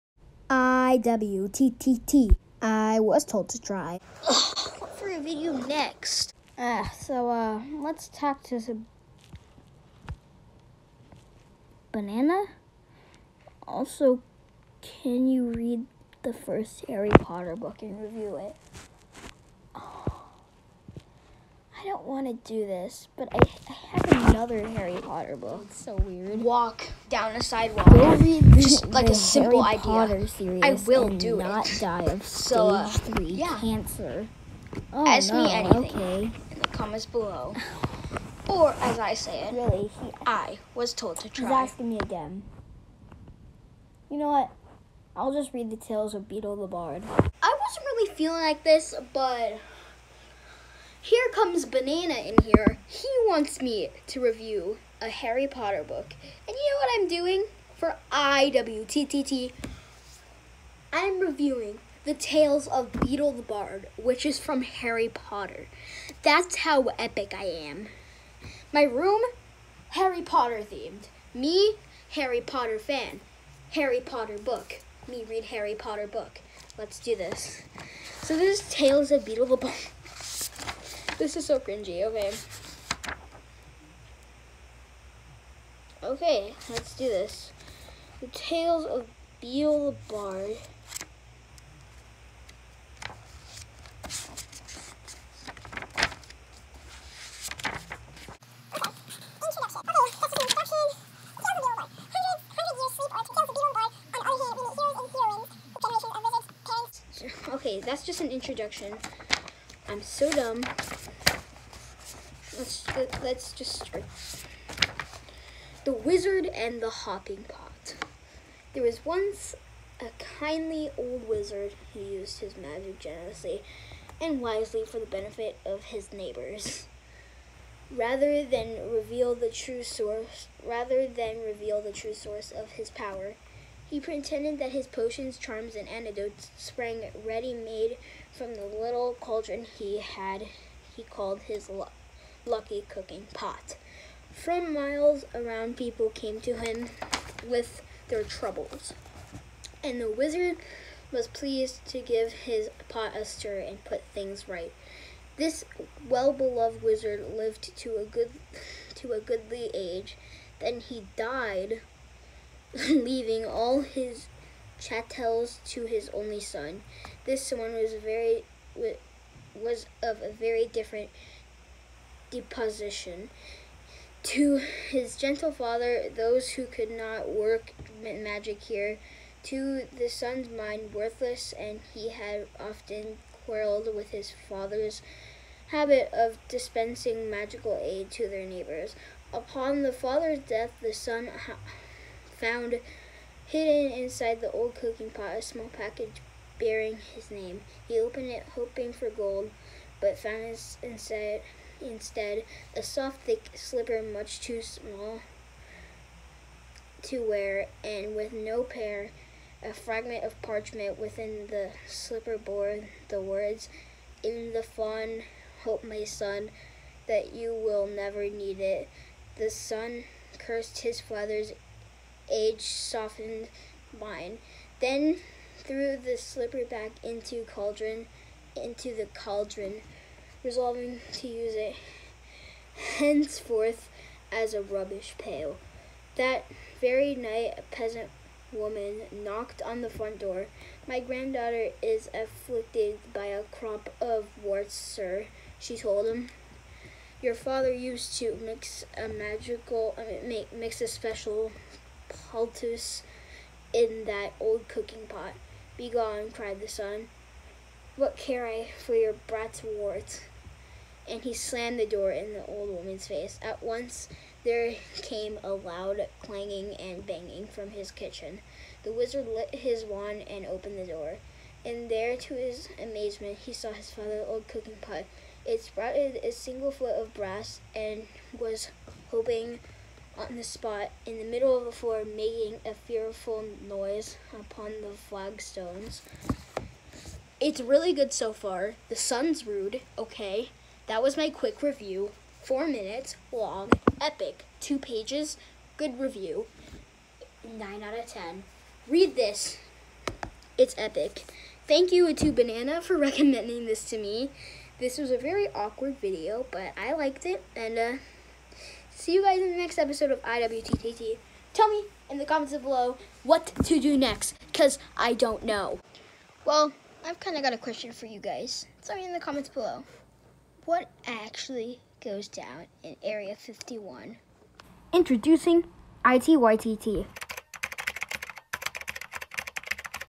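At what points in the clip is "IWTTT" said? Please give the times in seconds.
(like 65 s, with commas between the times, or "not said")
58 s, 310 s.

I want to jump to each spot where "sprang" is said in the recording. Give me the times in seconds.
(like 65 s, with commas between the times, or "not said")
136 s.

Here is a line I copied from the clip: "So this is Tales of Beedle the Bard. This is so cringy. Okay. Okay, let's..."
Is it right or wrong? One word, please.
right.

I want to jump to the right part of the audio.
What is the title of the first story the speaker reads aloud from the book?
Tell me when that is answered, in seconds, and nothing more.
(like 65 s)
115 s.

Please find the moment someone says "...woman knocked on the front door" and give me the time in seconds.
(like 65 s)
238 s.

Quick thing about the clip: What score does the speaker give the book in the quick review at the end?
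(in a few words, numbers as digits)
9 out of 10.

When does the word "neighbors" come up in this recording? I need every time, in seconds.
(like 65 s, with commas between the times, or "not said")
126 s, 188 s.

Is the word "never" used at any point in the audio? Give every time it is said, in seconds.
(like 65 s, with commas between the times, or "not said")
217 s.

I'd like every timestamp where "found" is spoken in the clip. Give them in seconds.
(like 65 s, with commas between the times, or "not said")
192 s, 200 s.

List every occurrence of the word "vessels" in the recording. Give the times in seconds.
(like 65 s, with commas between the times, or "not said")
not said.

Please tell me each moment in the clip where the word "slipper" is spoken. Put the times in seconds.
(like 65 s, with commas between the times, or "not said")
203 s, 211 s, 226 s.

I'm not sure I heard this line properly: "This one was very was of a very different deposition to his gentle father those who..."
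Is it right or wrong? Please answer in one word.
right.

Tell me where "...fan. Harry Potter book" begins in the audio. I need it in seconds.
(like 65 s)
72 s.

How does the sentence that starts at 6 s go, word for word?
Uh, so, uh, let's talk to some banana.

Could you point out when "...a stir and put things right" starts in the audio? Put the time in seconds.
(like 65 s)
153 s.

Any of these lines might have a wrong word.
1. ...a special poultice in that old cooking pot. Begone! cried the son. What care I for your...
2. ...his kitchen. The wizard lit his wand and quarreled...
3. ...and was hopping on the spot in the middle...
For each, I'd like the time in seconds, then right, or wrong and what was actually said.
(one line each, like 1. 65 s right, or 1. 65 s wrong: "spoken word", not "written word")
1. 250 s right
2. 267 s wrong: "opened", not "quarreled"
3. 277 s right.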